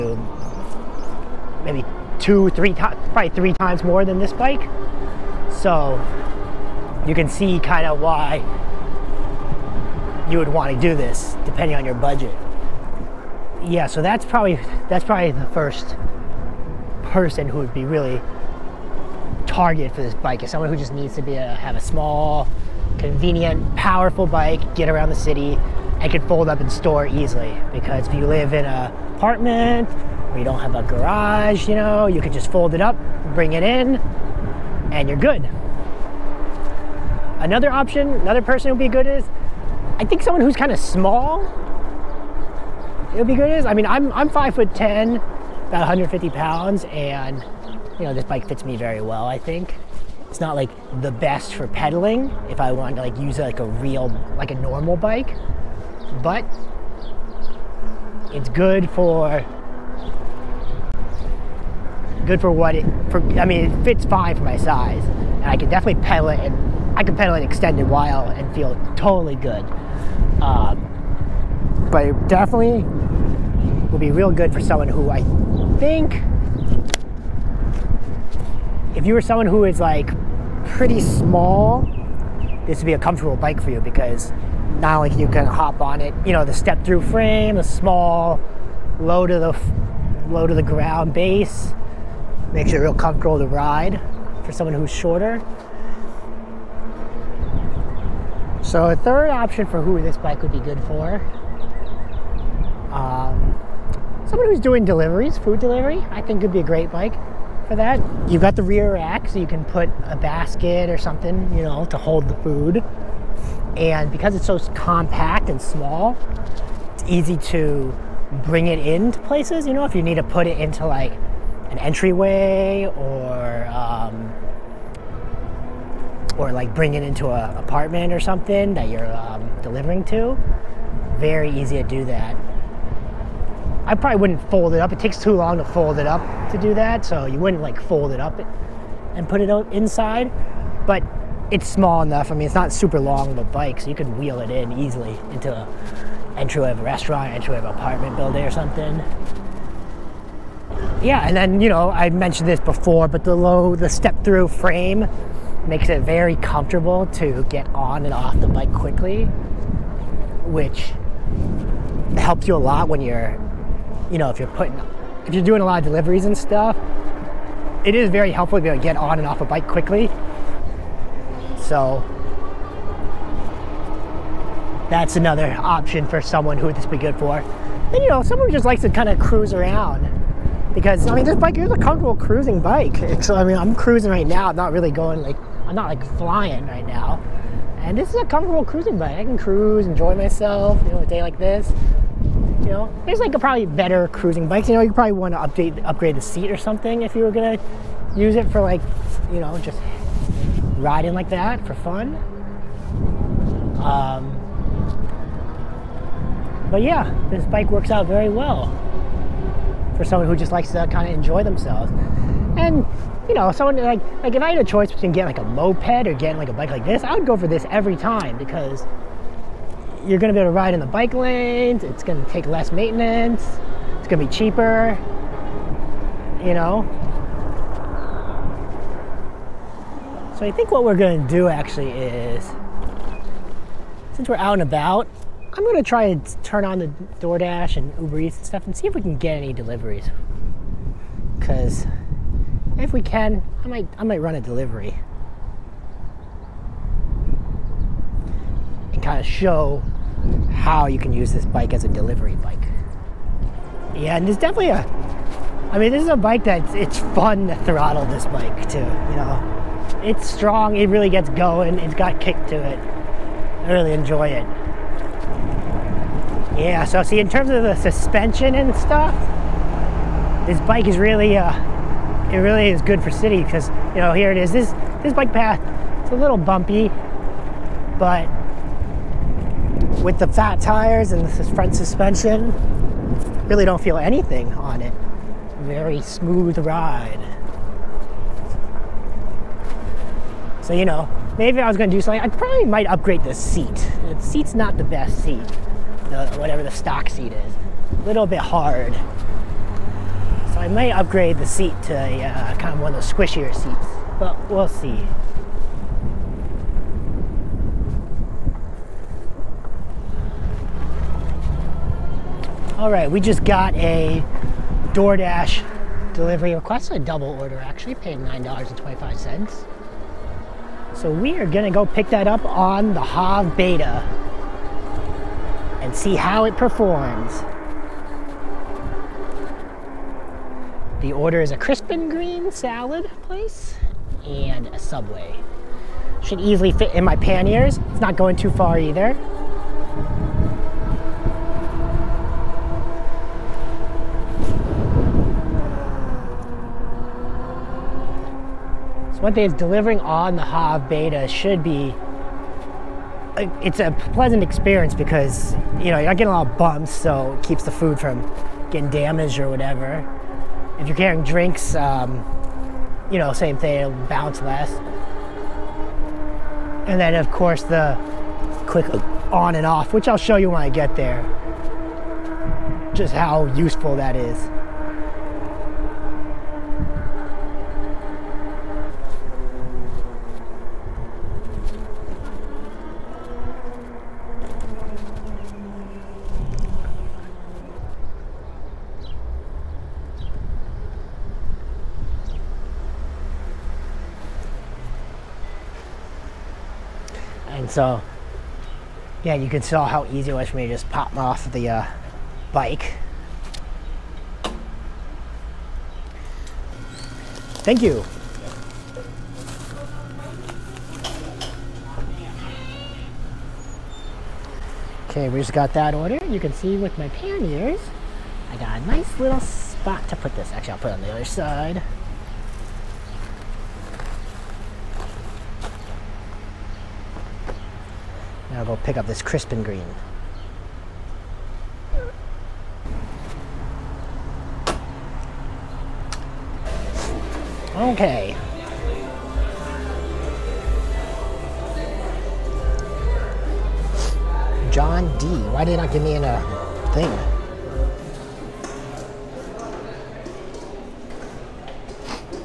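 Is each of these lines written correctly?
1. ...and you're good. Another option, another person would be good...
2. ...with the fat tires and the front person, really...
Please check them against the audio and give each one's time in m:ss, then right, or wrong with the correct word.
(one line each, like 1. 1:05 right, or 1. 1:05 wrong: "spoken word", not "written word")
1. 0:34 right
2. 4:40 wrong: "suspension", not "person".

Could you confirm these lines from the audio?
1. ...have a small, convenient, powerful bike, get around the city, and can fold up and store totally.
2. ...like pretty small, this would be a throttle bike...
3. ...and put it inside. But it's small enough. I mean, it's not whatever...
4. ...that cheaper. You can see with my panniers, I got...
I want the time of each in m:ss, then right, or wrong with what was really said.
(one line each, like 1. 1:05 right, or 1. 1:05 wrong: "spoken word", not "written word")
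1. 0:21 wrong: "easily", not "totally"
2. 1:19 wrong: "comfortable", not "throttle"
3. 2:19 wrong: "super", not "whatever"
4. 6:55 wrong: "order", not "cheaper".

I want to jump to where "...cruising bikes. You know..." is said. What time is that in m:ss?
3:14.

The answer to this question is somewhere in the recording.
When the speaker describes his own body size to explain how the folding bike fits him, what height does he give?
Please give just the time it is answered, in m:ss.
0:44.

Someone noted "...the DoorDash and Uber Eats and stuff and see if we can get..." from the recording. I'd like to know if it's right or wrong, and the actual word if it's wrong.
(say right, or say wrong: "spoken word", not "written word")
right.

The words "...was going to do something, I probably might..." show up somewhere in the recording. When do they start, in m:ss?
4:51.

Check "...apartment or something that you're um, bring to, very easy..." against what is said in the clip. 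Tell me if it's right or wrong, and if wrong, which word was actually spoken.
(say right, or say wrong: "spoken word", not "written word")
wrong: "delivering", not "bring".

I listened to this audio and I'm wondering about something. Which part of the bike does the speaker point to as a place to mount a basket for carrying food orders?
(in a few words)
rear rack.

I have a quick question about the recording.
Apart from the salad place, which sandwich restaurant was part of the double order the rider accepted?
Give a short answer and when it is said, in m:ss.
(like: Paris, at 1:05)
Subway, at 5:34.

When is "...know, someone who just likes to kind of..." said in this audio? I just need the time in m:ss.
2:58.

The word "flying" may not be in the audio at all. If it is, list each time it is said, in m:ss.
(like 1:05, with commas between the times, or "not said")
3:06.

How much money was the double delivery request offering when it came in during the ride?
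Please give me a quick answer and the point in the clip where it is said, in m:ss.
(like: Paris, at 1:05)
$9.25, at 5:18.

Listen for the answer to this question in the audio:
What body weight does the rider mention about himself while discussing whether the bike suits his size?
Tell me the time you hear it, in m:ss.
0:45.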